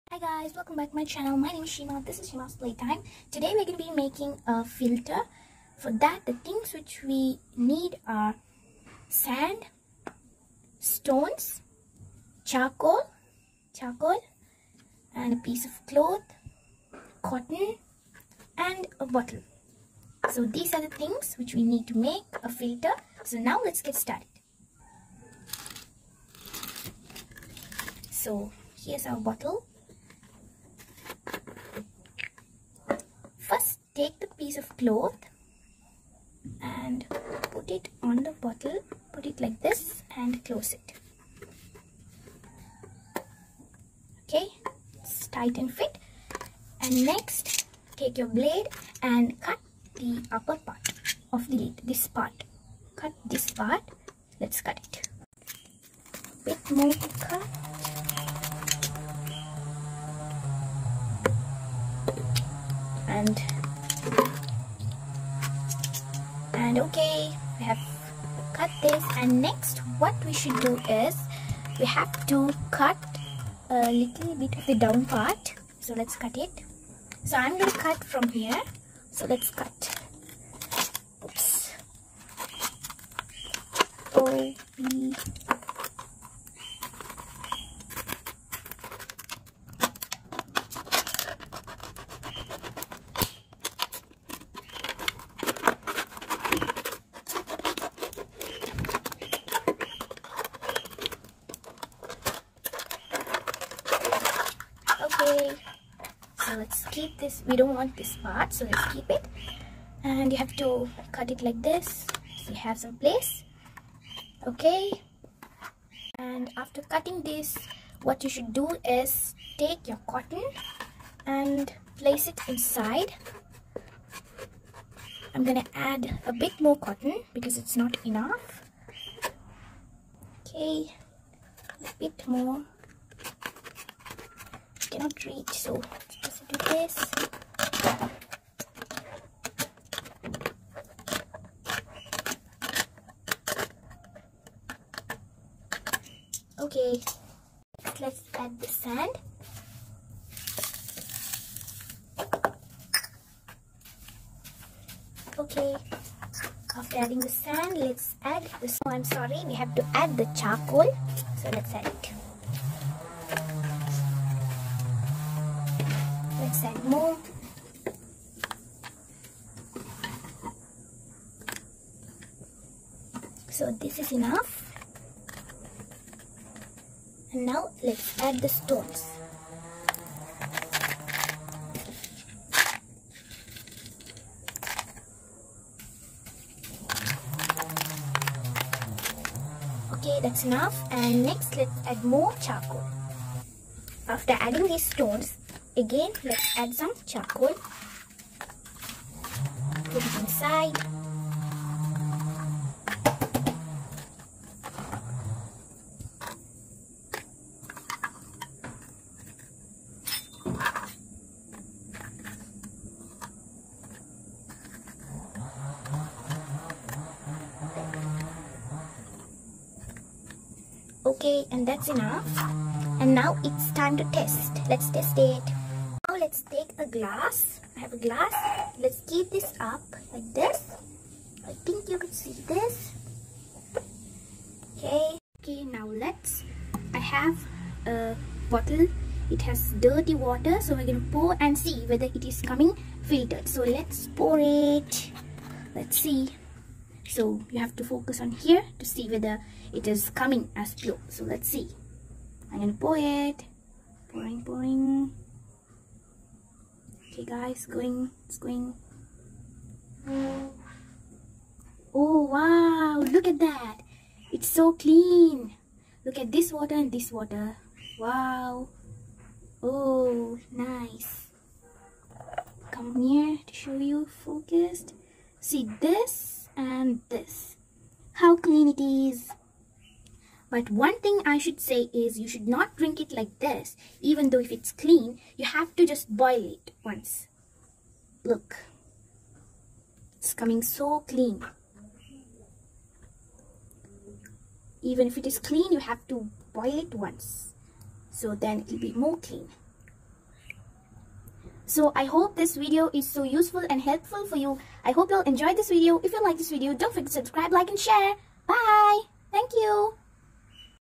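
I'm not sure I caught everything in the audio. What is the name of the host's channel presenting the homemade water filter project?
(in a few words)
Sheema's playtime.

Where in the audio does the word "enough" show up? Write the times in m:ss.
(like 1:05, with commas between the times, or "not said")
2:08, 2:54, 3:10, 3:41.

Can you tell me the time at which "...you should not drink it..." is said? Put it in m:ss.
4:42.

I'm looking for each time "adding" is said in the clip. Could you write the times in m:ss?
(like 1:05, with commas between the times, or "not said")
2:36, 3:14.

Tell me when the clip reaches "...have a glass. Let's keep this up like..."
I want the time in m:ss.
3:47.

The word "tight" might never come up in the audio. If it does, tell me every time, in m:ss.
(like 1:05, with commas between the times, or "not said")
0:45.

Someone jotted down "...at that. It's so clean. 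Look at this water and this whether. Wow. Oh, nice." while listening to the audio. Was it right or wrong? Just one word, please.
wrong.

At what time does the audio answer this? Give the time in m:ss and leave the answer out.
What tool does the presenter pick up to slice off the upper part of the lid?
0:48.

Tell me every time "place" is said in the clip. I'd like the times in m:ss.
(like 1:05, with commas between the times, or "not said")
1:52, 2:01.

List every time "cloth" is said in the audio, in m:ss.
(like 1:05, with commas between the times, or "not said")
0:15, 0:34.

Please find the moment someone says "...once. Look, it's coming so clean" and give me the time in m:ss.
4:46.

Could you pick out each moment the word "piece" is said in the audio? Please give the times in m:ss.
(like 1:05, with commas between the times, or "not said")
0:15, 0:34.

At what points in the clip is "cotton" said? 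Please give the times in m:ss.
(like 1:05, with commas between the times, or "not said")
0:17, 2:00, 2:06.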